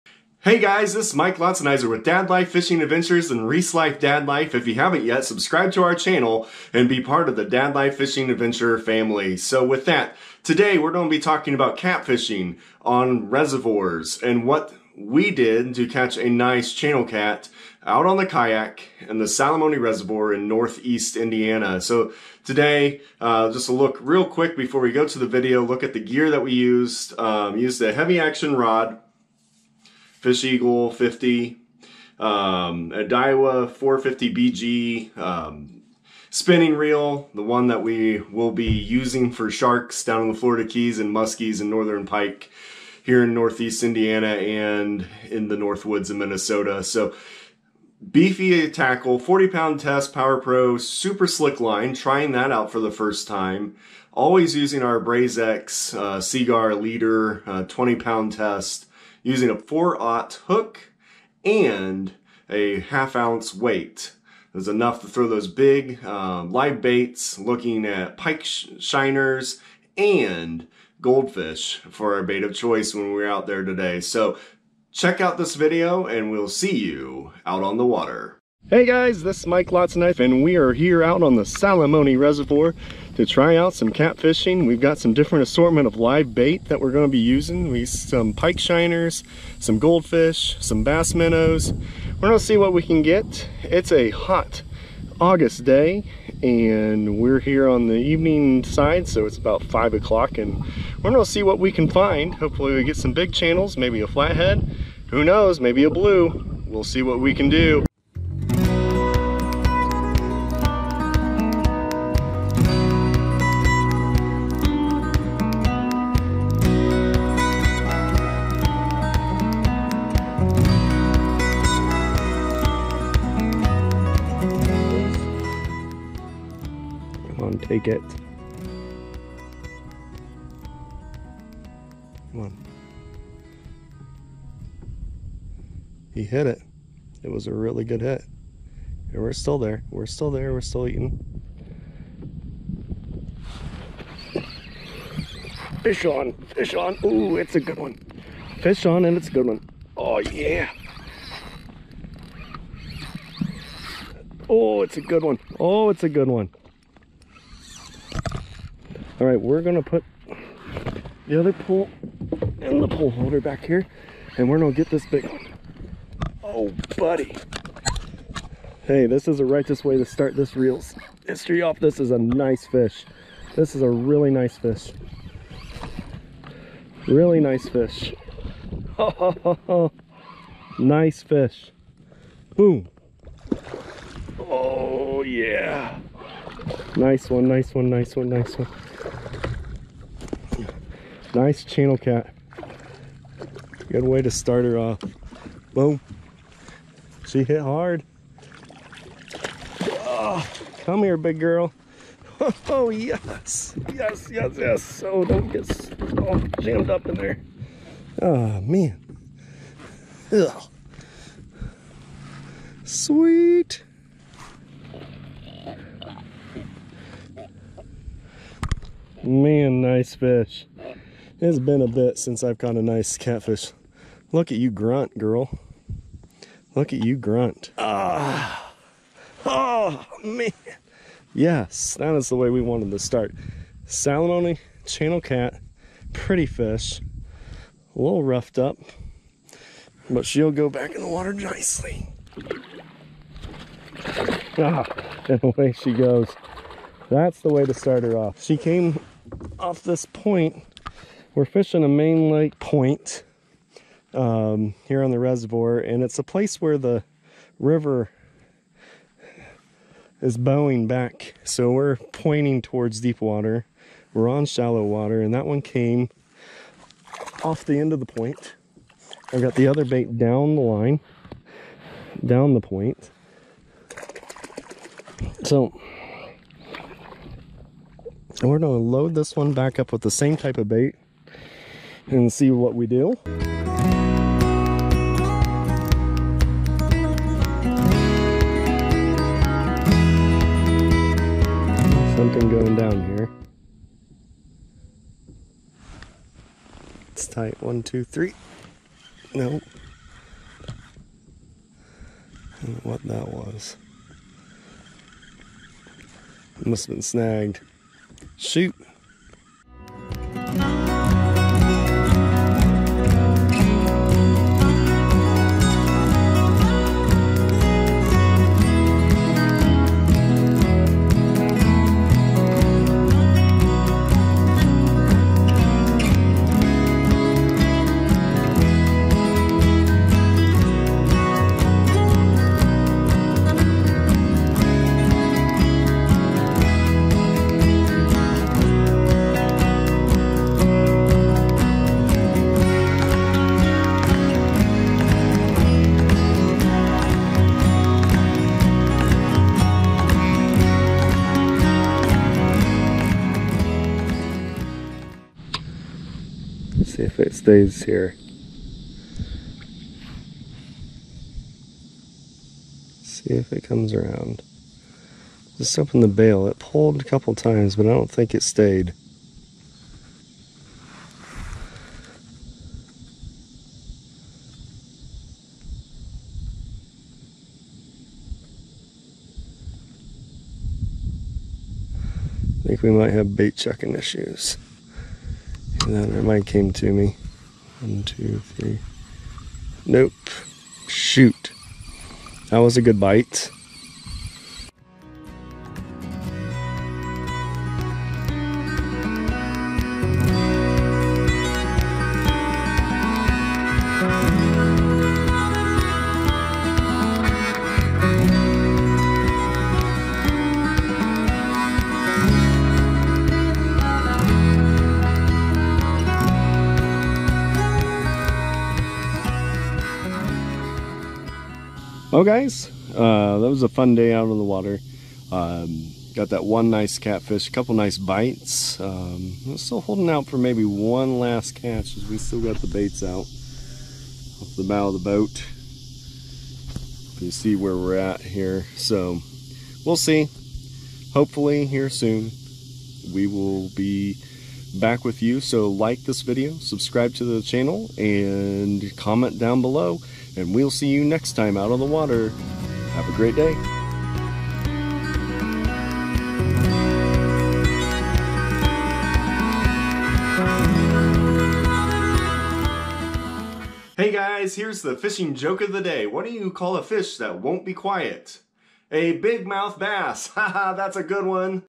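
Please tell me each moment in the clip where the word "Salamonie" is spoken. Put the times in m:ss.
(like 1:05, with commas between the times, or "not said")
0:19, 1:21, 3:53.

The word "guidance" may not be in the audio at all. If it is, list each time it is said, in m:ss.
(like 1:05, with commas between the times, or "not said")
not said.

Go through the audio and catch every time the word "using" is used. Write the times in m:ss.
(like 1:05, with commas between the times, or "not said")
0:38, 0:54, 0:59, 1:27.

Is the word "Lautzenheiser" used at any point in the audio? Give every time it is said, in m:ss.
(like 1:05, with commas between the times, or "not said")
0:01, 1:19.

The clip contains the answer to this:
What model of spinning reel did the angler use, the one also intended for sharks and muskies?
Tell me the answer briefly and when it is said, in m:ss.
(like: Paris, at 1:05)
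Daiwa 450BG, at 0:33.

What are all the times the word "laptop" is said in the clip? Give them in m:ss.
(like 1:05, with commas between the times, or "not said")
not said.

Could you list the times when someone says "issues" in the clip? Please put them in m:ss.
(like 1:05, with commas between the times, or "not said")
6:23.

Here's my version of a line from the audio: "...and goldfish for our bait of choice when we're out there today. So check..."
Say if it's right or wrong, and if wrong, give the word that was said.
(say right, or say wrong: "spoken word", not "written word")
right.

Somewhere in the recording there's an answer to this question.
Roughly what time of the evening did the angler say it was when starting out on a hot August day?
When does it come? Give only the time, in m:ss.
1:39.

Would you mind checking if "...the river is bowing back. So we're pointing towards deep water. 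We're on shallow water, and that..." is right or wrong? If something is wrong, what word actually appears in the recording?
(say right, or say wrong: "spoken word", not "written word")
right.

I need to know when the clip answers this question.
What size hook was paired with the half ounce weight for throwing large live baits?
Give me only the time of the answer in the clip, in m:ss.
0:59.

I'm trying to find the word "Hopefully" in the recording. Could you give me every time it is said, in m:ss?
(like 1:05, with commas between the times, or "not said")
1:42, 7:21.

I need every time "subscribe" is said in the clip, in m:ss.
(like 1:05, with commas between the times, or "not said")
0:05, 7:26.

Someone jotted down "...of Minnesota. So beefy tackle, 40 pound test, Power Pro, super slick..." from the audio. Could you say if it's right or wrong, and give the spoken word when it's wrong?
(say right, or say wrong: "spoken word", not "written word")
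right.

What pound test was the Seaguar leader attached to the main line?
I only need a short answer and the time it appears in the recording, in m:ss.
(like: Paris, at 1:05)
20, at 0:57.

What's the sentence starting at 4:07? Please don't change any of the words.
That's the way to start her off.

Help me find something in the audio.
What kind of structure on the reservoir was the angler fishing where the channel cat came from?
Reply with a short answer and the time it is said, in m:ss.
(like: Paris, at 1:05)
main lake point, at 4:11.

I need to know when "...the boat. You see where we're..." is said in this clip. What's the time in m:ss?
7:14.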